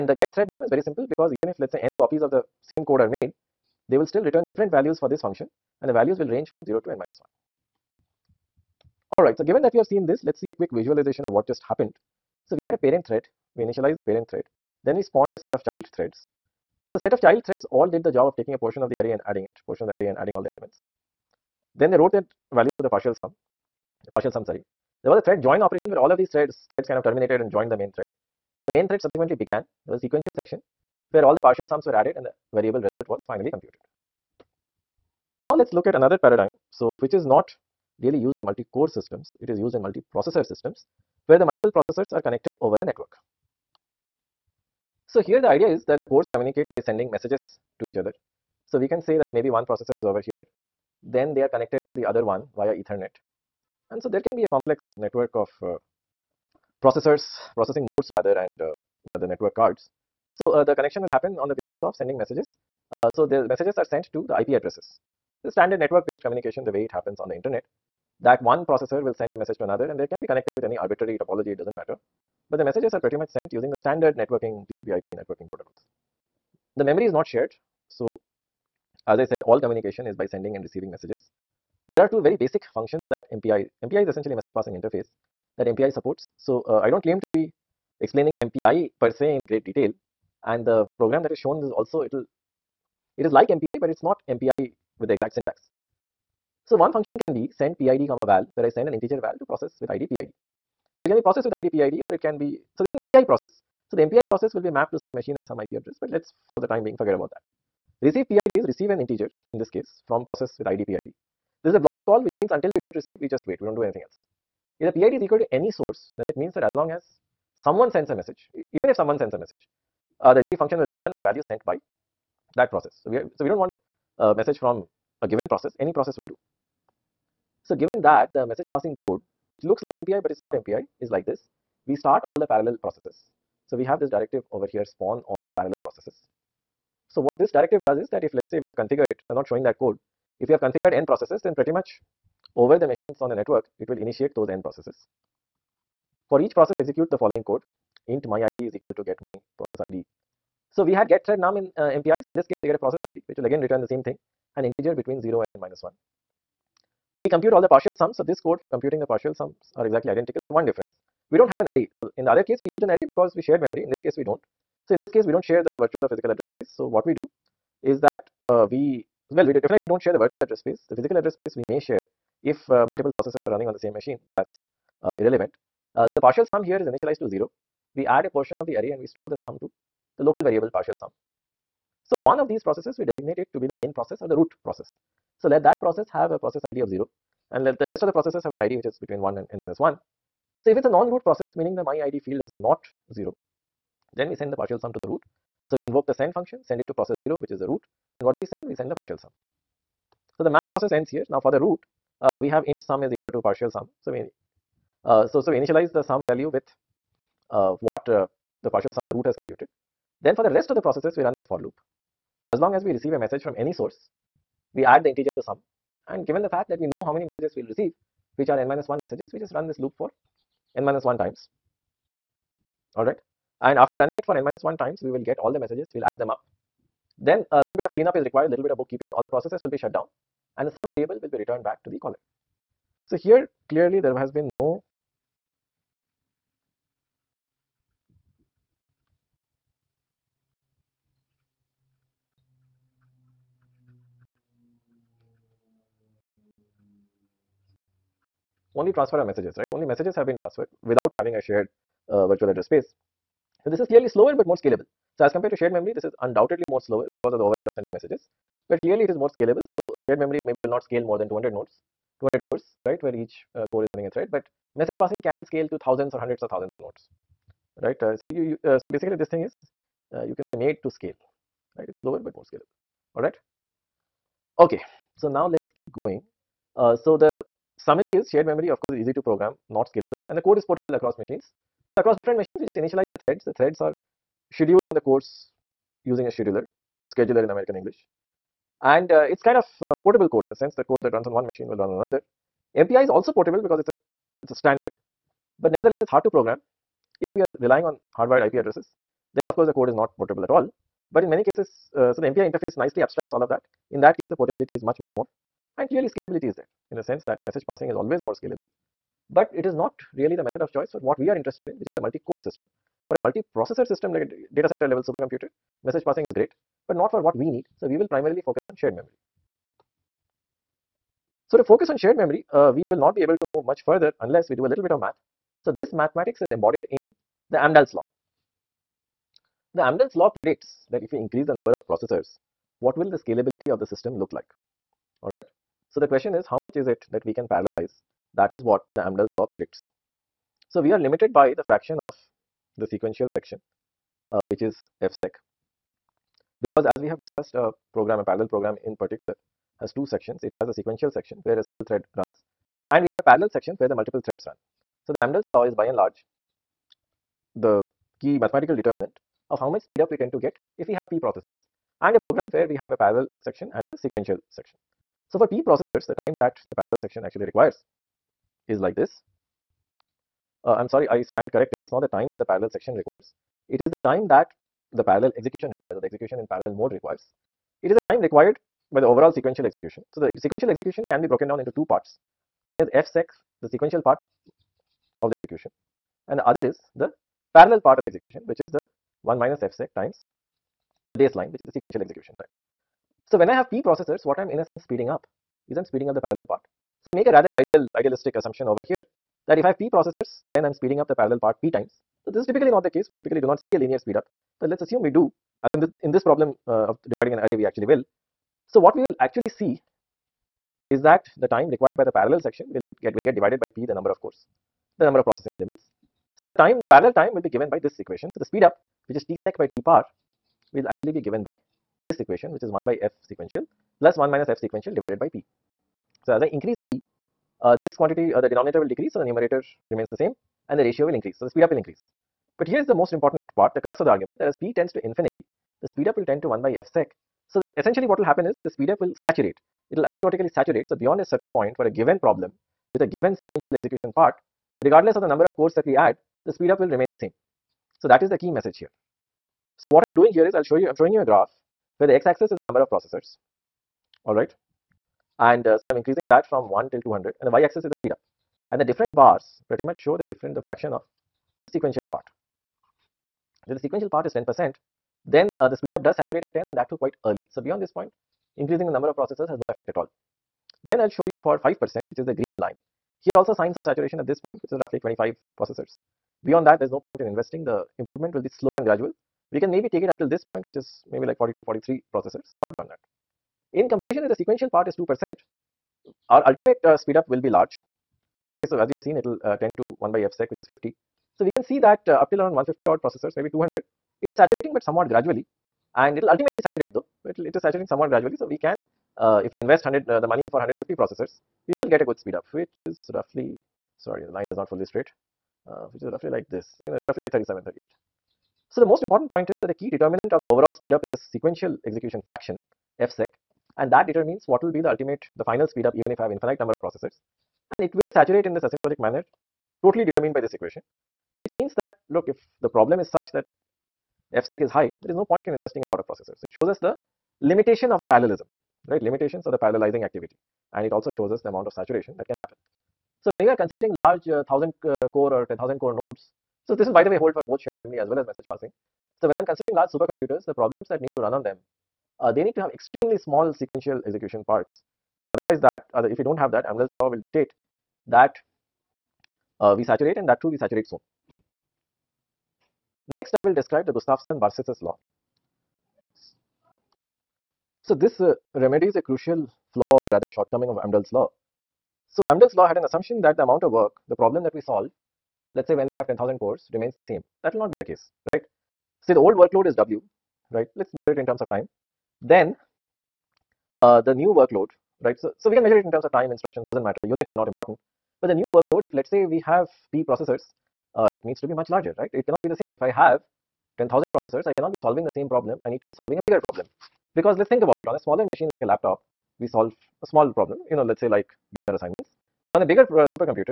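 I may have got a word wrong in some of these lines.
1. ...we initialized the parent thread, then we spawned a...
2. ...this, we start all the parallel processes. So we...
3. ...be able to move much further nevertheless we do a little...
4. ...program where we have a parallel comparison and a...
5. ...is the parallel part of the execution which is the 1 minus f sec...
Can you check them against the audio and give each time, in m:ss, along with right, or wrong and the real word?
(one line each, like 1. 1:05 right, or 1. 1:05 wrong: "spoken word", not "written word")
1. 0:13 right
2. 2:11 right
3. 5:23 wrong: "unless", not "nevertheless"
4. 6:02 wrong: "section", not "comparison"
5. 6:26 right.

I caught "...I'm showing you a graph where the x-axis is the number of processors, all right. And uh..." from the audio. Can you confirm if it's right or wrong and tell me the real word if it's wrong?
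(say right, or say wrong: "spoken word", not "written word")
right.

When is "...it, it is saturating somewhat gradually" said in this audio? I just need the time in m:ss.
8:17.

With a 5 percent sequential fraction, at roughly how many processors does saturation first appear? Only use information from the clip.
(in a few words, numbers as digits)
25.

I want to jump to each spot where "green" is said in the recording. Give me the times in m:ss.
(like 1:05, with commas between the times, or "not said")
7:52.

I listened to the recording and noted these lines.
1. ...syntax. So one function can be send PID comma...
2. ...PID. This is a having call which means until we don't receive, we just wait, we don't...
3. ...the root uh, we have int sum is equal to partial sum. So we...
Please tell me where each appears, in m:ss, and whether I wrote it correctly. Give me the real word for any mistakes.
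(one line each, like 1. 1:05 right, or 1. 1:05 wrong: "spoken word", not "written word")
1. 1:35 right
2. 1:50 wrong: "blocking", not "having"
3. 3:21 right.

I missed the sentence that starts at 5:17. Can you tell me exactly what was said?
So we will primarily focus on shared memory.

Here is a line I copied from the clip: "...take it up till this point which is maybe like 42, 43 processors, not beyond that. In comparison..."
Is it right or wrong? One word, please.
right.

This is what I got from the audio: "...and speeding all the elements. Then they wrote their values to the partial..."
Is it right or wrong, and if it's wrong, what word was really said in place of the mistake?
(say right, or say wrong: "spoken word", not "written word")
wrong: "adding", not "speeding".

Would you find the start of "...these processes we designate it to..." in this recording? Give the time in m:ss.
3:02.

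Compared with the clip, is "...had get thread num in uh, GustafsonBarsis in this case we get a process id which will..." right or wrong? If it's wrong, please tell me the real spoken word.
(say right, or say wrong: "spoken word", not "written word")
wrong: "MPIs", not "GustafsonBarsis".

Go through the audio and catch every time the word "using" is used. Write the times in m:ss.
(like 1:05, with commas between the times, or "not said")
1:13, 4:46.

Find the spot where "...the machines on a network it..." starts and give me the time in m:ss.
2:22.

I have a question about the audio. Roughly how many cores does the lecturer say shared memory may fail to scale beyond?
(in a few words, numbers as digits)
200.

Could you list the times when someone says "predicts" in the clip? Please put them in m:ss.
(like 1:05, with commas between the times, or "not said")
5:30, 5:39.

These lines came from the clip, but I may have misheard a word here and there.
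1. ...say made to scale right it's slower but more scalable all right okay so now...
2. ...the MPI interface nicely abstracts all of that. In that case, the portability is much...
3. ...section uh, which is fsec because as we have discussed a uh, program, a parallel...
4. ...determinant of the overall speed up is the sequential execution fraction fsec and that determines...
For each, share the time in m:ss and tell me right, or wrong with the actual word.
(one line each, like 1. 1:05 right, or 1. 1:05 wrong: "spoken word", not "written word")
1. 4:30 right
2. 5:02 right
3. 5:43 right
4. 8:29 right.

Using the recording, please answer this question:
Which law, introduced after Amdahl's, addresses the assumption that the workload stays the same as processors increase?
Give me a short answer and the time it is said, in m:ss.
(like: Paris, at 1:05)
Gustafson-Barsis's law, at 9:13.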